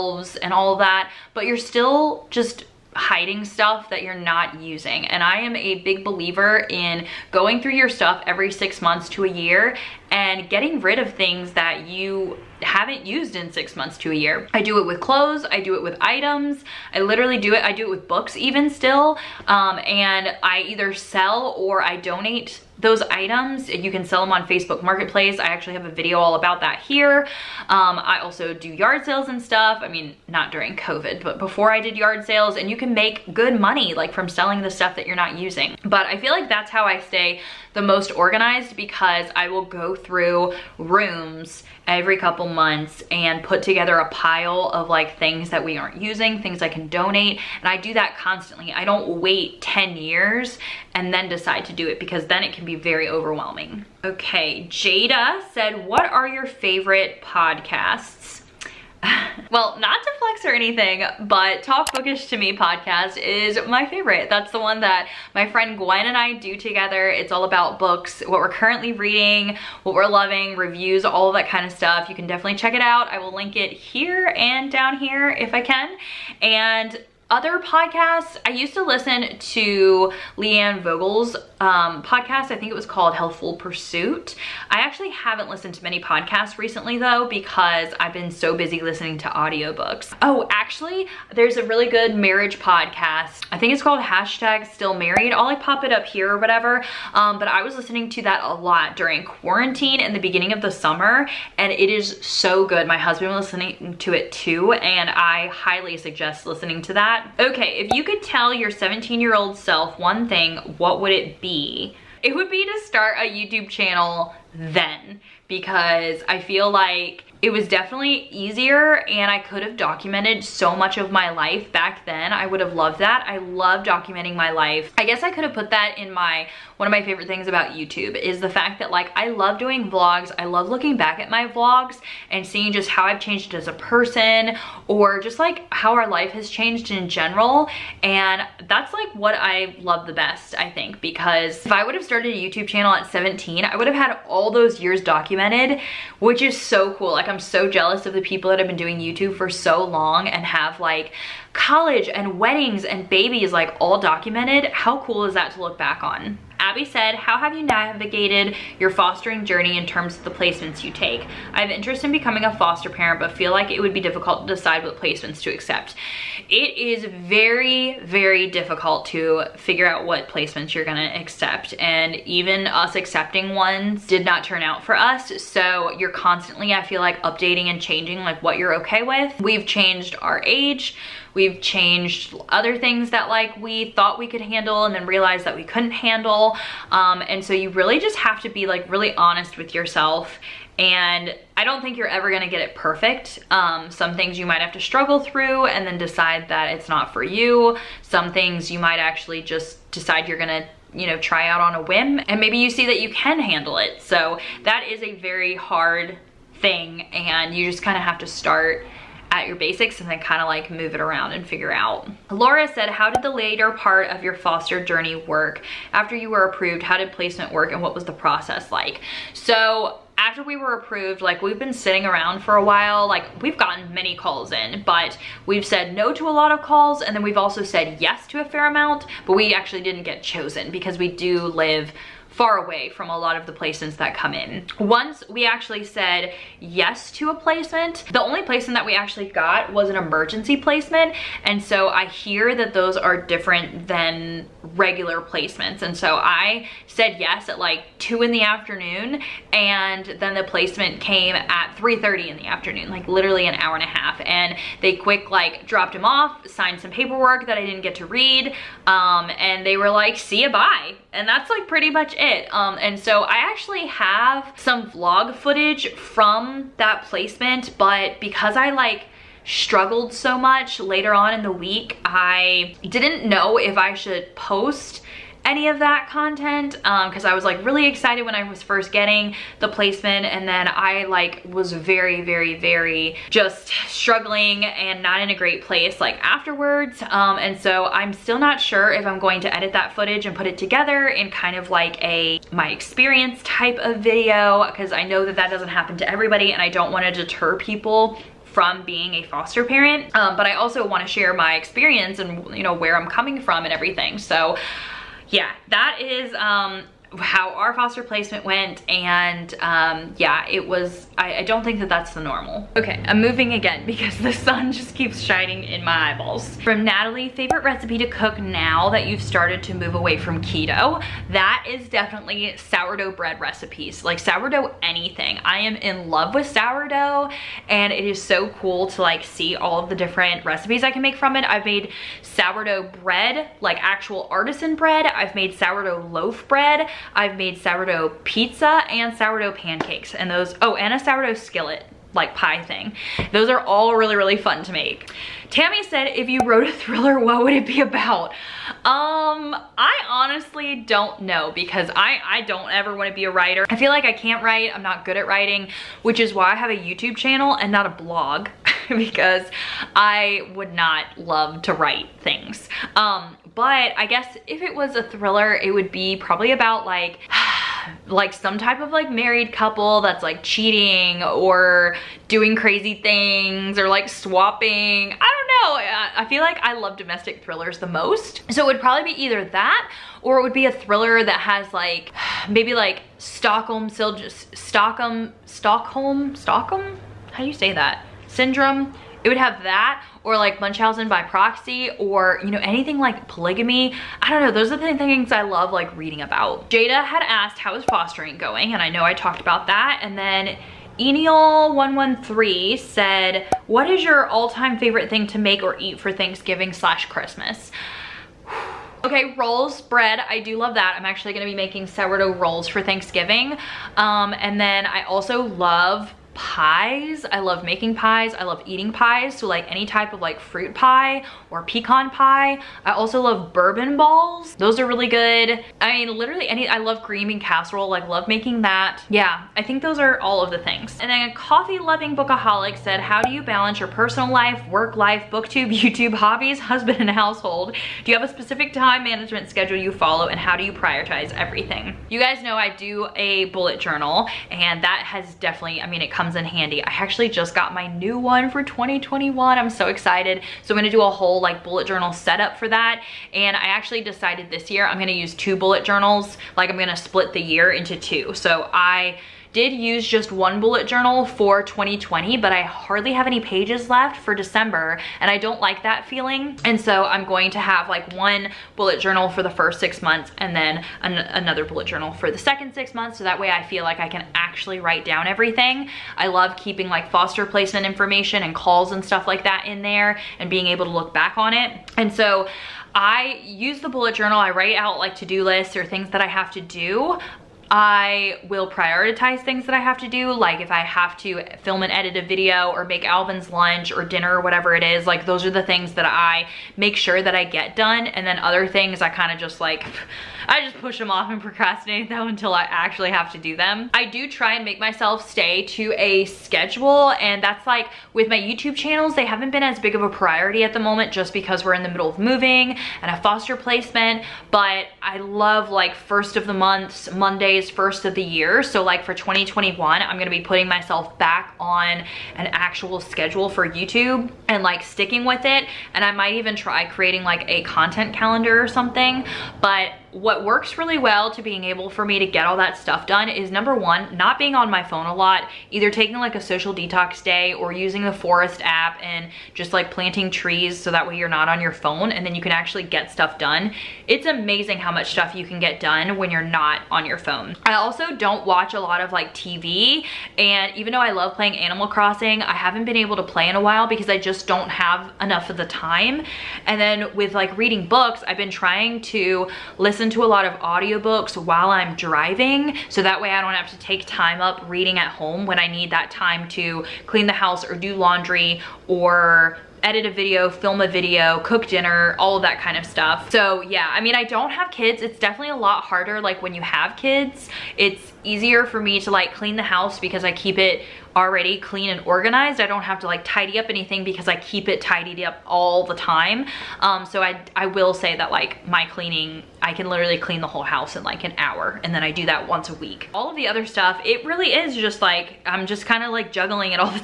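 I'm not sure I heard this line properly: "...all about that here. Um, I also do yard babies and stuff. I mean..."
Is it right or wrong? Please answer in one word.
wrong.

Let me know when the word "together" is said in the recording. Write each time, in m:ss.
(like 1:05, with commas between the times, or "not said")
0:43, 1:06, 4:50.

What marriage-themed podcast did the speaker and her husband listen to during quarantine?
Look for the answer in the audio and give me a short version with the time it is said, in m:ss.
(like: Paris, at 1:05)
Hashtag Stay Married, at 1:33.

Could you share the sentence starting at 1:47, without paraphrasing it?
Okay, if you could tell your 17 year old self one thing, what would it be?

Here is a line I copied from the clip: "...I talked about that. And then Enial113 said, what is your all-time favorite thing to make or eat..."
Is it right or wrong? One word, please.
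right.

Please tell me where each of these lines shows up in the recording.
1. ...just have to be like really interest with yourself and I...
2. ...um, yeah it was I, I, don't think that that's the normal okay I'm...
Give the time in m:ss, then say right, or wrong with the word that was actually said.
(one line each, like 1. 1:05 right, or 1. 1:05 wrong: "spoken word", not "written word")
1. 3:07 wrong: "honest", not "interest"
2. 5:09 right.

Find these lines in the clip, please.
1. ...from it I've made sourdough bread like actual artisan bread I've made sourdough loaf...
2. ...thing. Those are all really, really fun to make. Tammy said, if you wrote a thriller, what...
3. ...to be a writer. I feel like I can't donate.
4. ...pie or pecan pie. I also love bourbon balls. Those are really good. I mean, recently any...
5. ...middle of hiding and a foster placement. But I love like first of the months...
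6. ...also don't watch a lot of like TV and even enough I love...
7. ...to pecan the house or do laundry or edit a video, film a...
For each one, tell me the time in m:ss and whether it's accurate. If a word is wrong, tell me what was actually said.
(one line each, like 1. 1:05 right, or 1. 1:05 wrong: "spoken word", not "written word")
1. 5:31 right
2. 5:42 right
3. 5:53 wrong: "write", not "donate"
4. 7:00 wrong: "literally", not "recently"
5. 8:31 wrong: "moving", not "hiding"
6. 9:07 wrong: "though", not "enough"
7. 9:26 wrong: "clean", not "pecan".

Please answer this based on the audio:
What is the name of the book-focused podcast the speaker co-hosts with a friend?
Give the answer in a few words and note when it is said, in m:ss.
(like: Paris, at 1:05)
Talk Bookish to Me, at 1:01.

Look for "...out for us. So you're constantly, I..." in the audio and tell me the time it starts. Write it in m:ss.
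2:54.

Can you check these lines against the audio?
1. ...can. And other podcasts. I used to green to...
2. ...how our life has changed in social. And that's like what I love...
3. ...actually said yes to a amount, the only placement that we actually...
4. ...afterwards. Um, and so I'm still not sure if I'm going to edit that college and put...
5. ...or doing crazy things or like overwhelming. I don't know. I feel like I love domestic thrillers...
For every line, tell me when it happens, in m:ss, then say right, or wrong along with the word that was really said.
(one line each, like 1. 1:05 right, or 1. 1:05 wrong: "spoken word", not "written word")
1. 1:15 wrong: "listen", not "green"
2. 2:15 wrong: "general", not "social"
3. 3:55 wrong: "placement", not "amount"
4. 4:46 wrong: "footage", not "college"
5. 6:11 wrong: "swapping", not "overwhelming".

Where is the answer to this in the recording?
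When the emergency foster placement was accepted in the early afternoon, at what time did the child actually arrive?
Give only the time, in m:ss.
4:11.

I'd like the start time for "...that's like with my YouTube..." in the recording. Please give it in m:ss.
8:27.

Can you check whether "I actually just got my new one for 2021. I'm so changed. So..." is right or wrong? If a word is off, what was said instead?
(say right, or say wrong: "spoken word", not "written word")
wrong: "excited", not "changed".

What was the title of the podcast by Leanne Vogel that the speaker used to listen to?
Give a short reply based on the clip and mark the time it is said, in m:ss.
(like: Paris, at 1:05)
Healthful Pursuit, at 1:23.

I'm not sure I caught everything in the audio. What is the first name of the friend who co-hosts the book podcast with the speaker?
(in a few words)
Gwen.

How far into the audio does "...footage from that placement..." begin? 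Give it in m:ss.
4:25.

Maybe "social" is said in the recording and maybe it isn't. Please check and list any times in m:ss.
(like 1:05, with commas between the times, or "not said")
8:56.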